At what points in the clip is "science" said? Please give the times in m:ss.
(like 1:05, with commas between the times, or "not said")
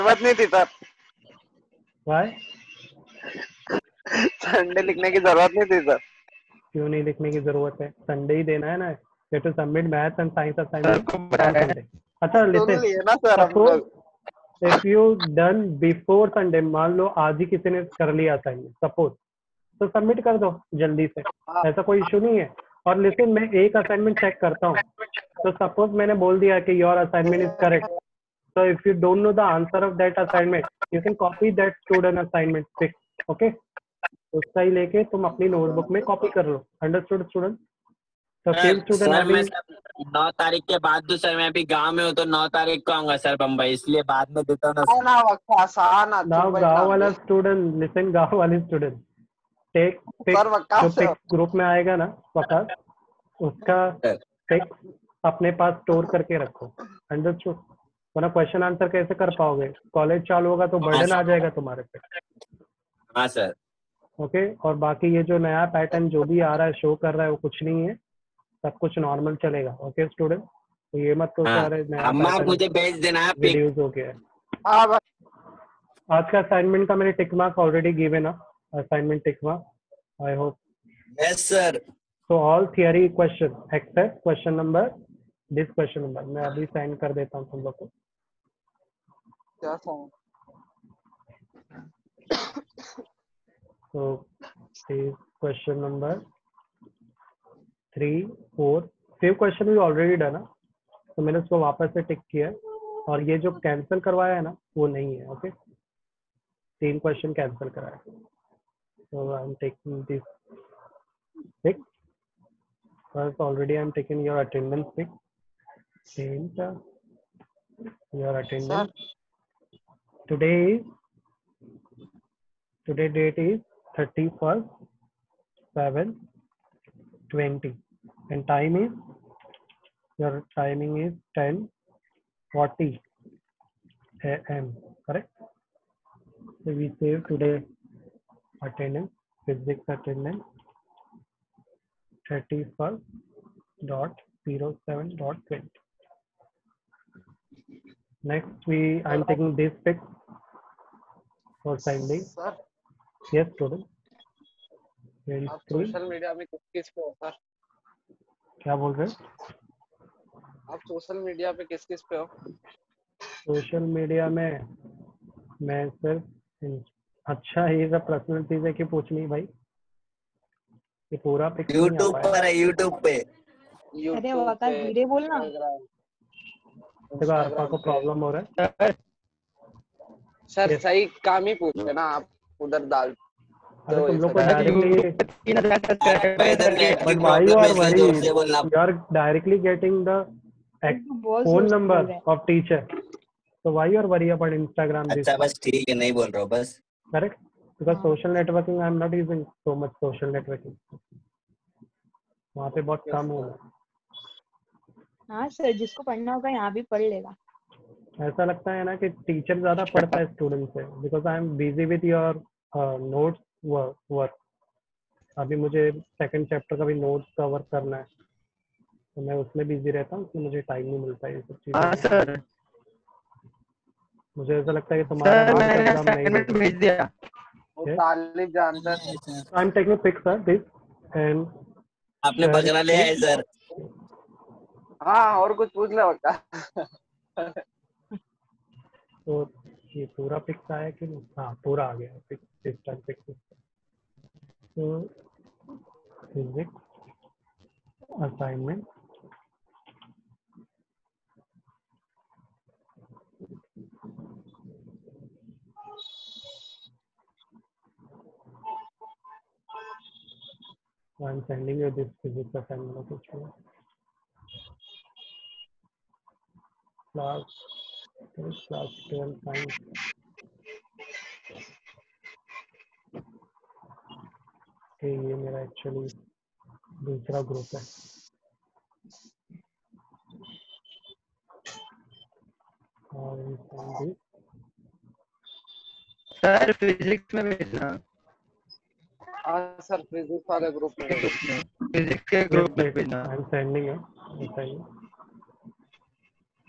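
4:29.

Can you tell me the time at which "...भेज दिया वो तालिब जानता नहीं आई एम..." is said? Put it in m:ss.
3:46.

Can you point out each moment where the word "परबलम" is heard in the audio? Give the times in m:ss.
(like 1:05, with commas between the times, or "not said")
2:57.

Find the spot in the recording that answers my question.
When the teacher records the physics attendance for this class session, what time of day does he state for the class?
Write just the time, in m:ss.
2:11.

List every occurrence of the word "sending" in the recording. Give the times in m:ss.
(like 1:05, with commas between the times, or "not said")
4:21.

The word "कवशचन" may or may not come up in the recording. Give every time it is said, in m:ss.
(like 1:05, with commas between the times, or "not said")
0:58, 1:47.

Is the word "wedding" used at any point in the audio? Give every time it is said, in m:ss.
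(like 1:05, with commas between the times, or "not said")
not said.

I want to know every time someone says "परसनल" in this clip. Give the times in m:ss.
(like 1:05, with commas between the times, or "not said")
2:48.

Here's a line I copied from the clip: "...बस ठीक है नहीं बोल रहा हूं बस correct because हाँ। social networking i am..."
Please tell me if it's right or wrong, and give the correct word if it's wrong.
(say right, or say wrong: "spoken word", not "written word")
right.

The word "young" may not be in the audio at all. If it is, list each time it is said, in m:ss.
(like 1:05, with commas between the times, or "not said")
not said.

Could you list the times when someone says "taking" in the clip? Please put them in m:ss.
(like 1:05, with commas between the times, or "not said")
1:49, 1:53, 2:29.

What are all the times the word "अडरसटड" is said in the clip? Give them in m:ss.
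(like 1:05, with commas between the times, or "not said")
0:36, 0:57.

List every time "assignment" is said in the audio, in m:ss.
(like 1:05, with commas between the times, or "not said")
1:18, 4:22.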